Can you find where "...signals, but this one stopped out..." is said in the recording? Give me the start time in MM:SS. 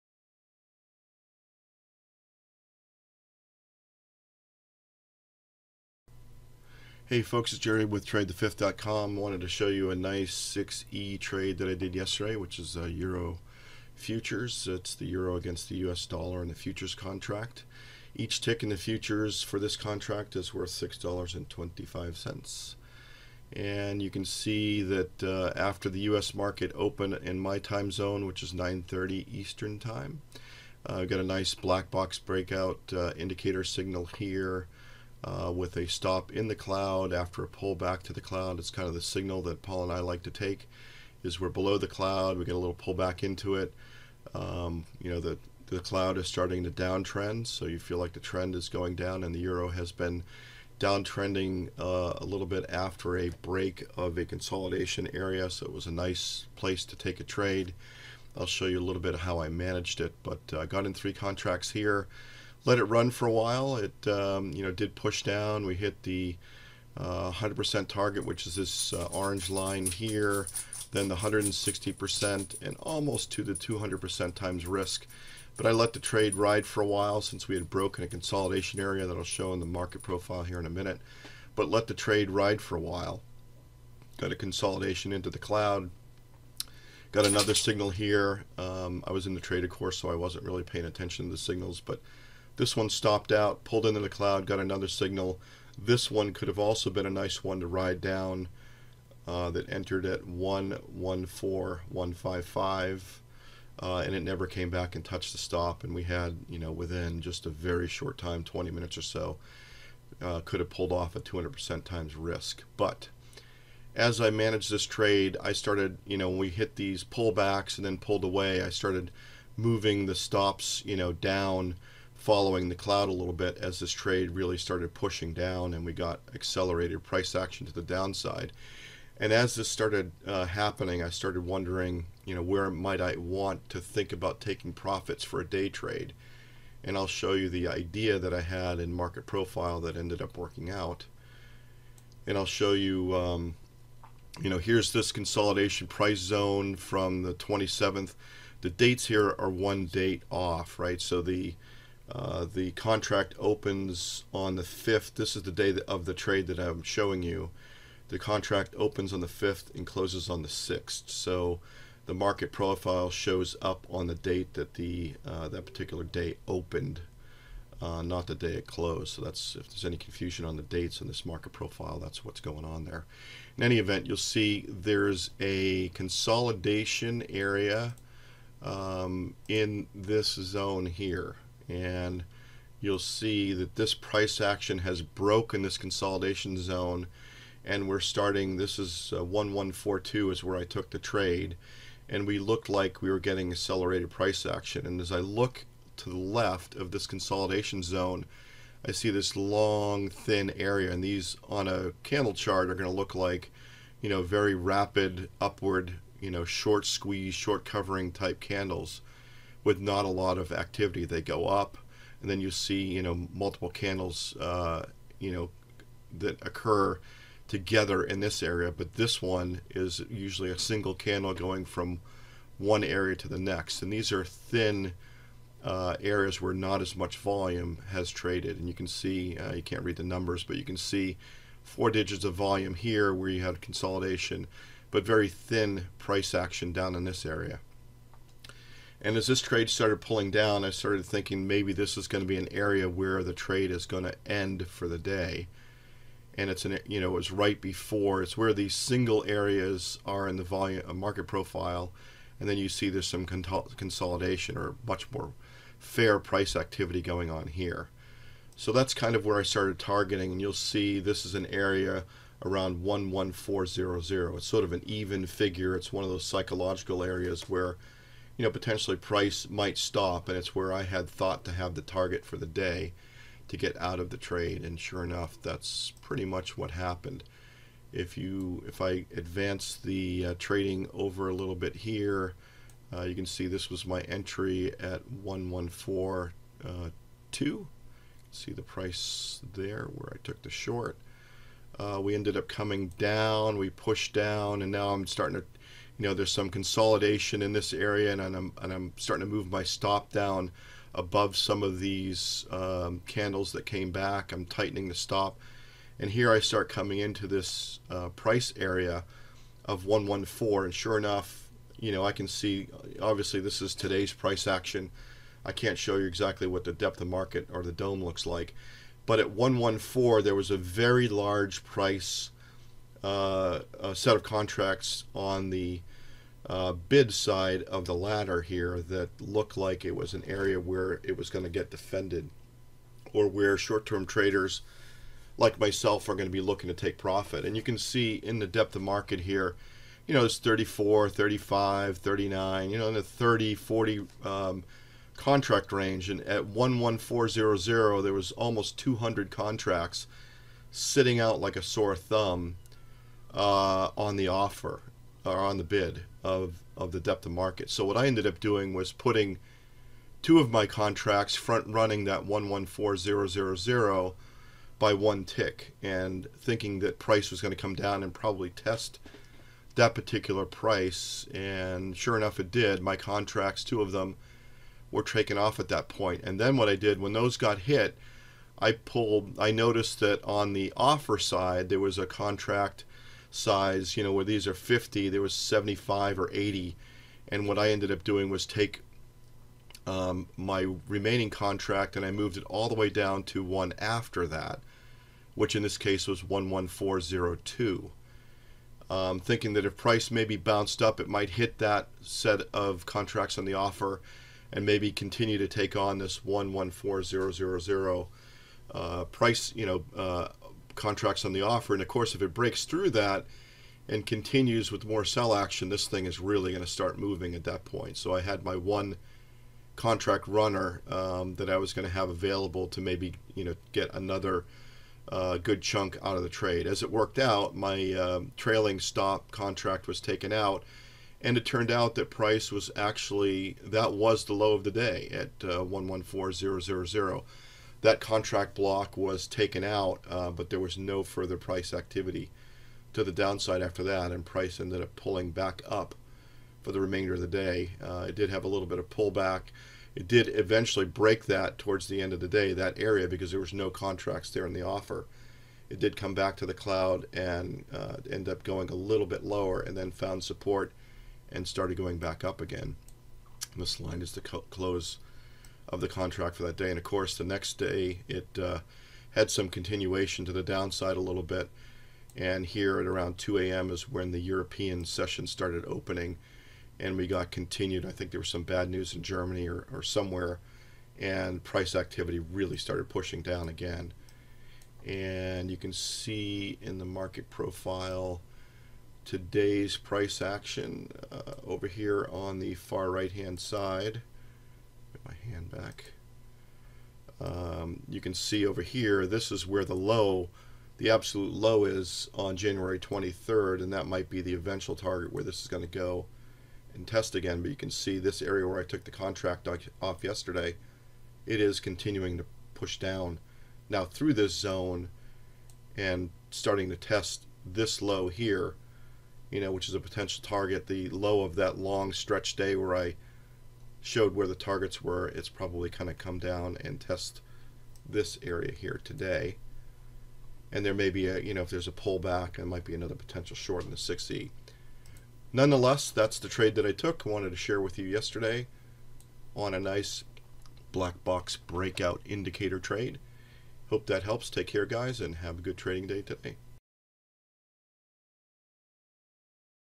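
01:31.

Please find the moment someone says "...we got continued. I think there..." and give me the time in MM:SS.
07:56.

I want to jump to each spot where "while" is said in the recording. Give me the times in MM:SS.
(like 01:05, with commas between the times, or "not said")
01:03, 01:16, 01:22.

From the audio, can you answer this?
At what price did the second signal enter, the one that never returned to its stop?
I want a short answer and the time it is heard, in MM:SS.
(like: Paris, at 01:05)
114155, at 01:40.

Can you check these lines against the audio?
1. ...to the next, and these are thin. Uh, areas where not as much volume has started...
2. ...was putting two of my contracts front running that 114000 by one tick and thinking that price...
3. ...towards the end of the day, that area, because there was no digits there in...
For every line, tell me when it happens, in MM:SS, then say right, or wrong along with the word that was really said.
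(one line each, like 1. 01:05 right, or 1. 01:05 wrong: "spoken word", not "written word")
1. 03:43 wrong: "traded", not "started"
2. 05:58 right
3. 07:31 wrong: "contracts", not "digits".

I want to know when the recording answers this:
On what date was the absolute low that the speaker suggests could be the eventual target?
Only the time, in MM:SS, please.
08:22.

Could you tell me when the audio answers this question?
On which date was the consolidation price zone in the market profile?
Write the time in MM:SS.
02:27.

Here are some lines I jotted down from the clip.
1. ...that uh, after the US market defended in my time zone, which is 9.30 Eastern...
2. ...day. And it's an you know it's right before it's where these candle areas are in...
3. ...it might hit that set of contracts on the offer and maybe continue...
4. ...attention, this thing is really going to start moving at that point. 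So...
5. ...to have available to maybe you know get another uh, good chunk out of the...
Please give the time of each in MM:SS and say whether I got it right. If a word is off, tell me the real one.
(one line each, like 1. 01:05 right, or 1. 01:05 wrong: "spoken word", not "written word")
1. 00:24 wrong: "opened", not "defended"
2. 04:04 wrong: "single", not "candle"
3. 06:40 right
4. 06:55 wrong: "action", not "attention"
5. 07:01 right.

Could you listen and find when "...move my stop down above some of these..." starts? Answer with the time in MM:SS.
04:59.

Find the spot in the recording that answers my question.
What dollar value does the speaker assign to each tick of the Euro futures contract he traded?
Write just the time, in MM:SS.
00:20.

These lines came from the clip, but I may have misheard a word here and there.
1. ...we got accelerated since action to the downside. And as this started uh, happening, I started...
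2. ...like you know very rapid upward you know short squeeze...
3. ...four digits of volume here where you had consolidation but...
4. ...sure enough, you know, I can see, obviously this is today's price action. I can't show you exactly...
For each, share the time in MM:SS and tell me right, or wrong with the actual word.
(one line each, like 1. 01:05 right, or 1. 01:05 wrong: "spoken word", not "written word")
1. 02:05 wrong: "price", not "since"
2. 03:23 right
3. 03:51 right
4. 05:10 right.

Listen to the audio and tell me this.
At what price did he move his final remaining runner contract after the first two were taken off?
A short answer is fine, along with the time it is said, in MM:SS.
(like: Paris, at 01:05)
11402, at 06:36.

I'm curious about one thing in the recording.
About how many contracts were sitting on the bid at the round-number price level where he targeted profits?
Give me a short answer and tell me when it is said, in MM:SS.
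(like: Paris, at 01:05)
200, at 05:48.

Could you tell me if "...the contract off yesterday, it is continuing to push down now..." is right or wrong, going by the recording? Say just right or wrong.
right.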